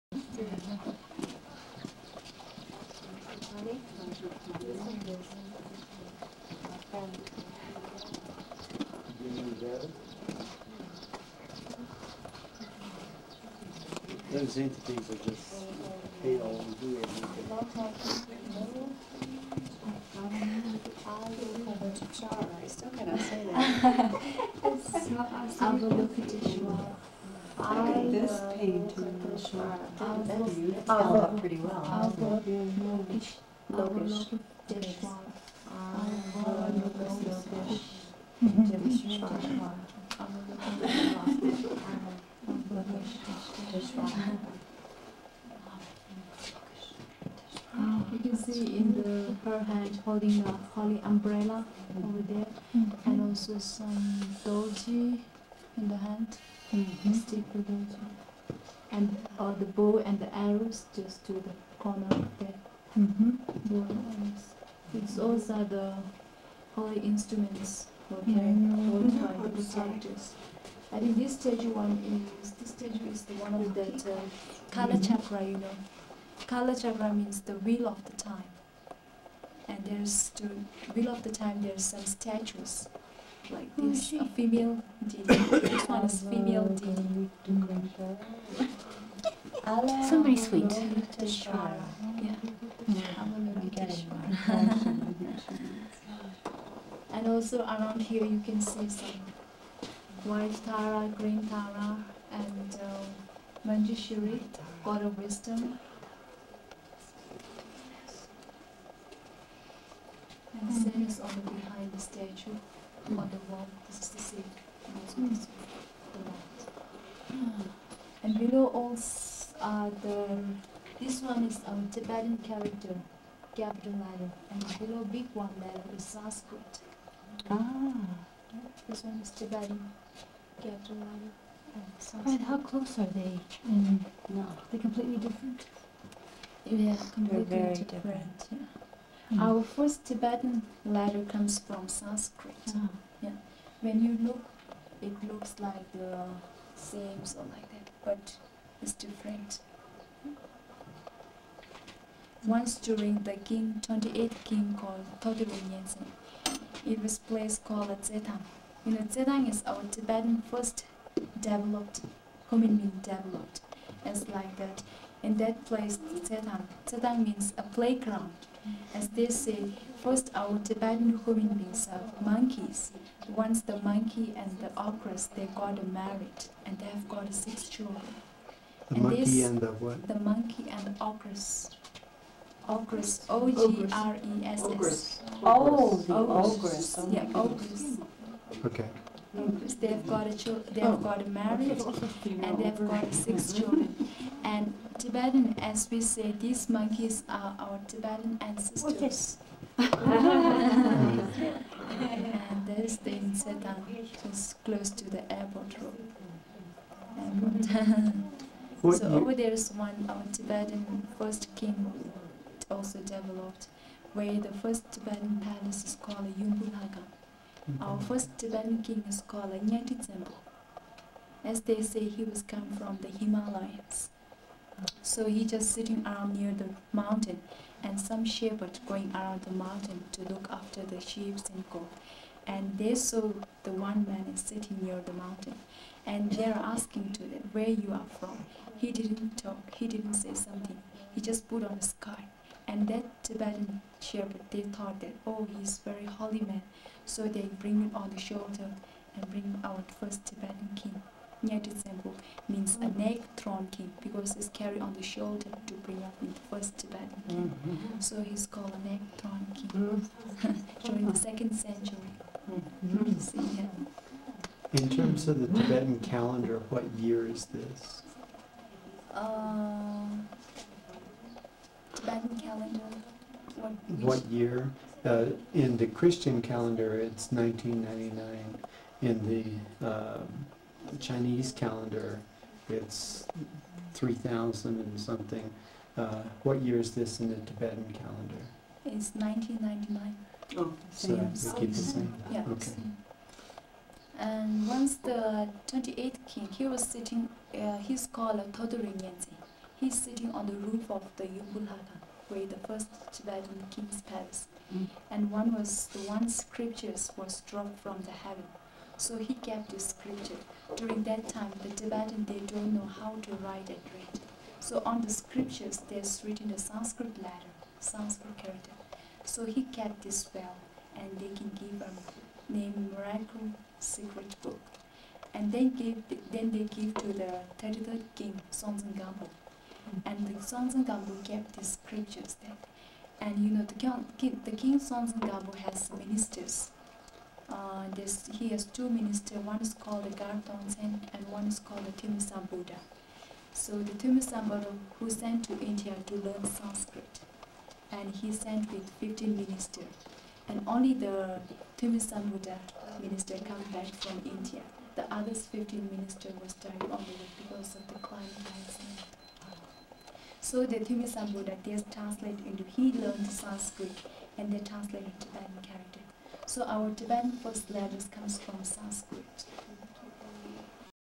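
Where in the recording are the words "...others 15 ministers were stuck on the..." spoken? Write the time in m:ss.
5:55.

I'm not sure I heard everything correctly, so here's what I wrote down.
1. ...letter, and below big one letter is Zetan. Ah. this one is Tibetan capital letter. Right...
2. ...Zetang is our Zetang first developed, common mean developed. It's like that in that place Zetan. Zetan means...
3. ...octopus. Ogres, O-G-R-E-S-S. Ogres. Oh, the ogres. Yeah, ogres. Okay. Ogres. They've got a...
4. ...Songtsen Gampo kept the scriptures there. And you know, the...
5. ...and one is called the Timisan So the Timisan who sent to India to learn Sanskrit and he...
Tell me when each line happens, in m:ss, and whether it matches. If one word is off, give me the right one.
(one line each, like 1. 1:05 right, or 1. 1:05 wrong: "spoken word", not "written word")
1. 2:04 wrong: "Sanskrit", not "Zetan"
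2. 2:39 wrong: "Tibetan", not "Zetang"
3. 3:01 right
4. 5:30 right
5. 5:41 right.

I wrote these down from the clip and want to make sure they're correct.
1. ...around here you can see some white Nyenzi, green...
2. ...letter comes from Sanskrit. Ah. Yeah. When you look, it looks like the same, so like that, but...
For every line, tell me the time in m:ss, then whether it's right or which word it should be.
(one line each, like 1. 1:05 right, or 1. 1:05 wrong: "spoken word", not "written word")
1. 1:37 wrong: "Tara", not "Nyenzi"
2. 2:20 right.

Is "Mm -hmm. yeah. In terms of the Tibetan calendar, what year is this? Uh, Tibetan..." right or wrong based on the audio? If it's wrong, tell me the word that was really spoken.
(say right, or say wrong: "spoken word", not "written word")
right.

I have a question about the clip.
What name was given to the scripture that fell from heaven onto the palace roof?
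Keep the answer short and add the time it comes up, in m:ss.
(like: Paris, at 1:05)
Miracle Secret Book, at 5:22.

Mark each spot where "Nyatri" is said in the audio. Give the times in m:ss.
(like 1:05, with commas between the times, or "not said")
3:39.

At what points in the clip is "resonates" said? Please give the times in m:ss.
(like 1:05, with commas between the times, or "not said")
not said.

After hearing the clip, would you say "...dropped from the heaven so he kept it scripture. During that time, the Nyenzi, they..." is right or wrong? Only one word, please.
wrong.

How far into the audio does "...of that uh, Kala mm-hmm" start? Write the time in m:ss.
1:13.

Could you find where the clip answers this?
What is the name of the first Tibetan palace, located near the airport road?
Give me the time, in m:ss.
3:36.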